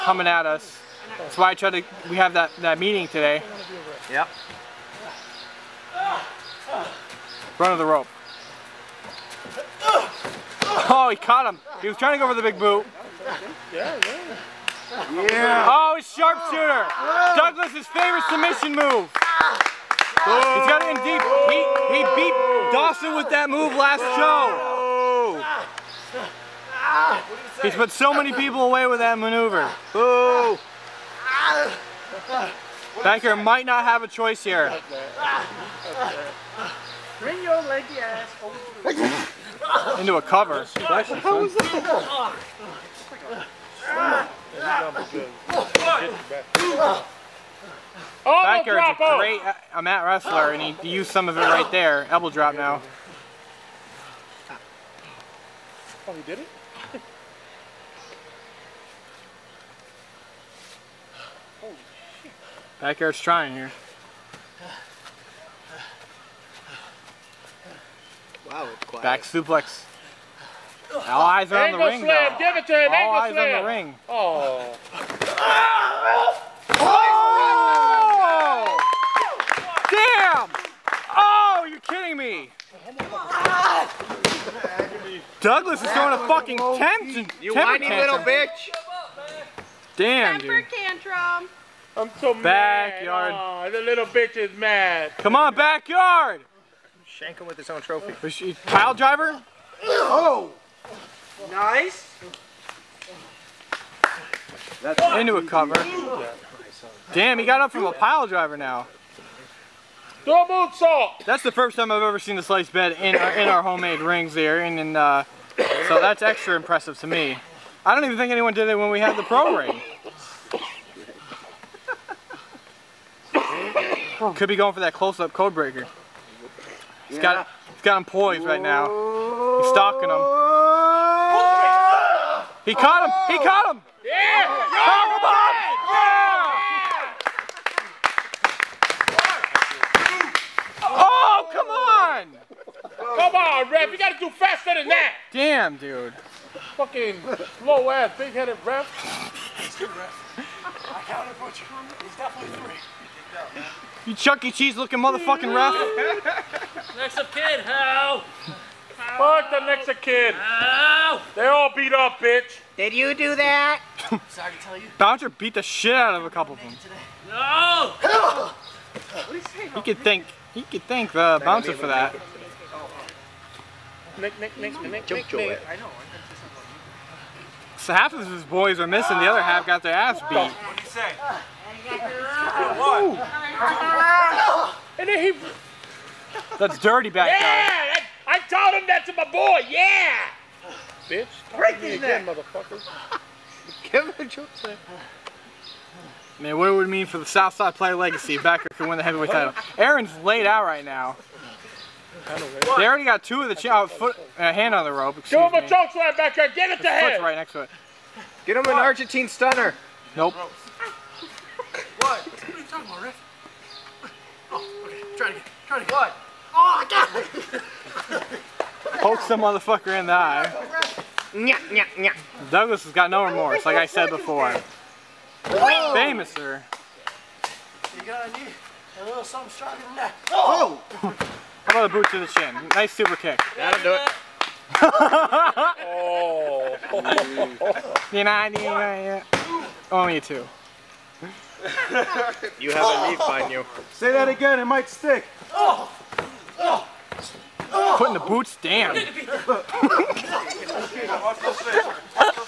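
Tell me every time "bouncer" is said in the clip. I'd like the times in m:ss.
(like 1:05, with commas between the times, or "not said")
2:44, 2:51.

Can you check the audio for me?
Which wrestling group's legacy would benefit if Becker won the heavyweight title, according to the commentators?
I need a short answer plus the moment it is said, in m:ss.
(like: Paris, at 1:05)
Southside, at 3:17.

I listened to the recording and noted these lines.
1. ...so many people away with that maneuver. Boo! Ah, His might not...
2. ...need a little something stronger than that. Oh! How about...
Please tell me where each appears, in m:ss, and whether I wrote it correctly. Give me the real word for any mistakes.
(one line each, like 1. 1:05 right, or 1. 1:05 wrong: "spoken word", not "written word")
1. 0:27 wrong: "Banker", not "His"
2. 3:48 right.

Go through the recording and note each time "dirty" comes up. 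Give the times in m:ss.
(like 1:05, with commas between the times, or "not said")
3:06.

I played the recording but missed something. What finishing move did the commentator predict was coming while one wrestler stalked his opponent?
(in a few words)
Code breaker.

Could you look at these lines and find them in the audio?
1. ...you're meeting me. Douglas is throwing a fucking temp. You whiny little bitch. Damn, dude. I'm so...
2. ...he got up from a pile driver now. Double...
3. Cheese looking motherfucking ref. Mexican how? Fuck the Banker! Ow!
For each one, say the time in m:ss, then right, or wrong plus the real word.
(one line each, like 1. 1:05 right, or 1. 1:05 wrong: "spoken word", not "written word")
1. 1:21 wrong: "kidding", not "meeting"
2. 1:47 right
3. 2:34 wrong: "Mexican", not "Banker".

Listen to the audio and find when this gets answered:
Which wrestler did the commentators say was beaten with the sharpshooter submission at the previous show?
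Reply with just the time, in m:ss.
0:22.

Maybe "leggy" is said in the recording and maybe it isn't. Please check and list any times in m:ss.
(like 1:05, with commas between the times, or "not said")
0:37.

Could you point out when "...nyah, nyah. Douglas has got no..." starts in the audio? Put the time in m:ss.
3:41.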